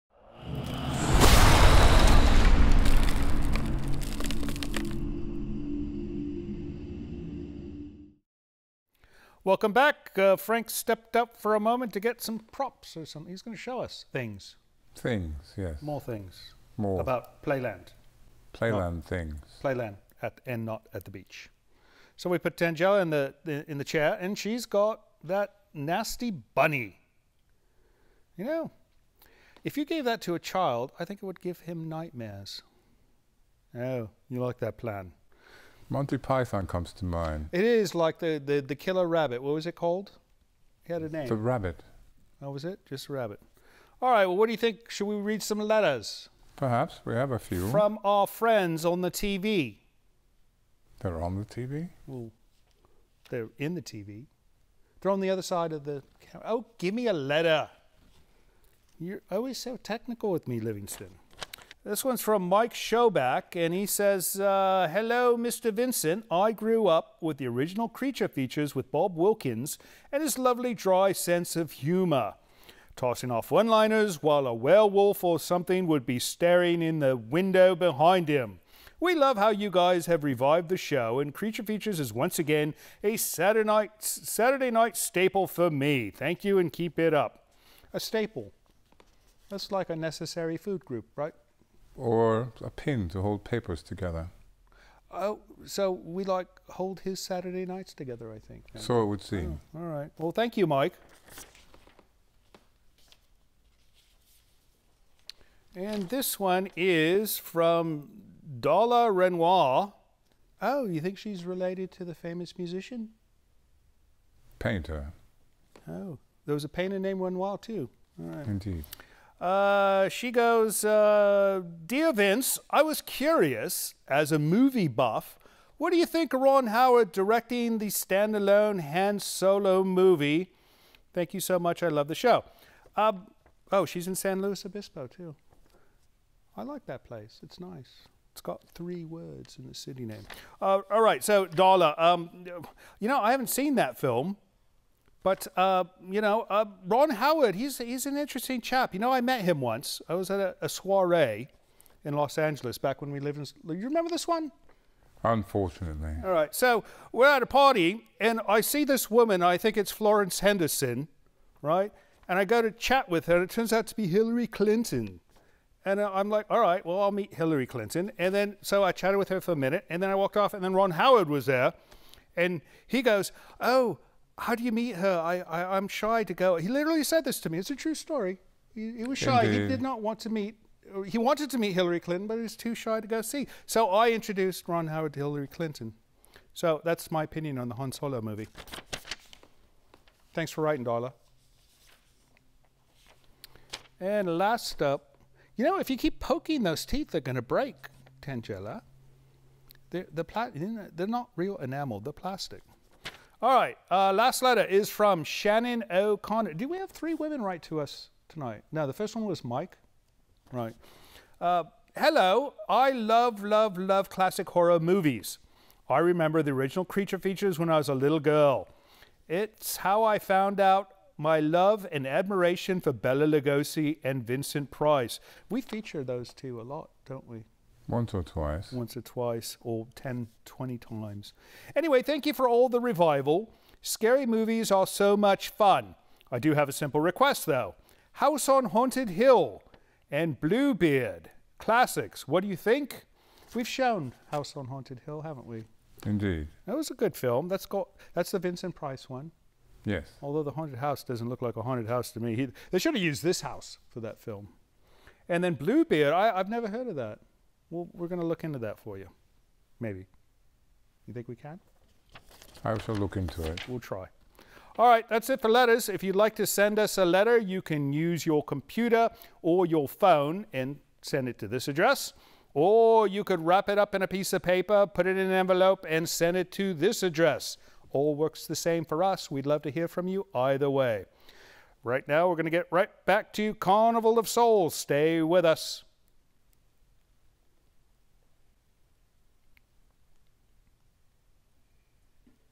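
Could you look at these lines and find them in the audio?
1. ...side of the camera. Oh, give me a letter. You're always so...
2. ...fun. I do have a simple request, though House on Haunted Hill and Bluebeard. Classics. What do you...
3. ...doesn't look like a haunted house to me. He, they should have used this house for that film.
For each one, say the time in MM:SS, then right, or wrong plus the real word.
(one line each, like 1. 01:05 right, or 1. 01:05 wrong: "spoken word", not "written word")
1. 00:55 right
2. 03:55 right
3. 04:11 right.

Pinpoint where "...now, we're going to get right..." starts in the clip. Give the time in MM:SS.
04:42.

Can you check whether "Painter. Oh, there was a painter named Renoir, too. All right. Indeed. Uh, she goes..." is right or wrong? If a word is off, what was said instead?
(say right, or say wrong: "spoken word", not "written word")
right.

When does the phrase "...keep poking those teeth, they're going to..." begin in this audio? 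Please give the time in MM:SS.
03:15.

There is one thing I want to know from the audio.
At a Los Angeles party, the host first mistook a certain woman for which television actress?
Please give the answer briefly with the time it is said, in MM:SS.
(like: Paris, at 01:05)
Florence Henderson, at 02:39.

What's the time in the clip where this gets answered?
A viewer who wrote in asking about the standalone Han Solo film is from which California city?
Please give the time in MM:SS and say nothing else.
02:14.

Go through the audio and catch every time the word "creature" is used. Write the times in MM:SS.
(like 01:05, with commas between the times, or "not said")
01:07, 01:21, 03:36.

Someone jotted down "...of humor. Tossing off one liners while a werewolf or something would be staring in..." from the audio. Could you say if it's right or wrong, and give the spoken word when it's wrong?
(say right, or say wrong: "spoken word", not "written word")
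right.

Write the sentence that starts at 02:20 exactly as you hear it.
Uh, all right, so Dala, um, you know, I haven't seen that film.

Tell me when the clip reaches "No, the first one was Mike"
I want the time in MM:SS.
03:28.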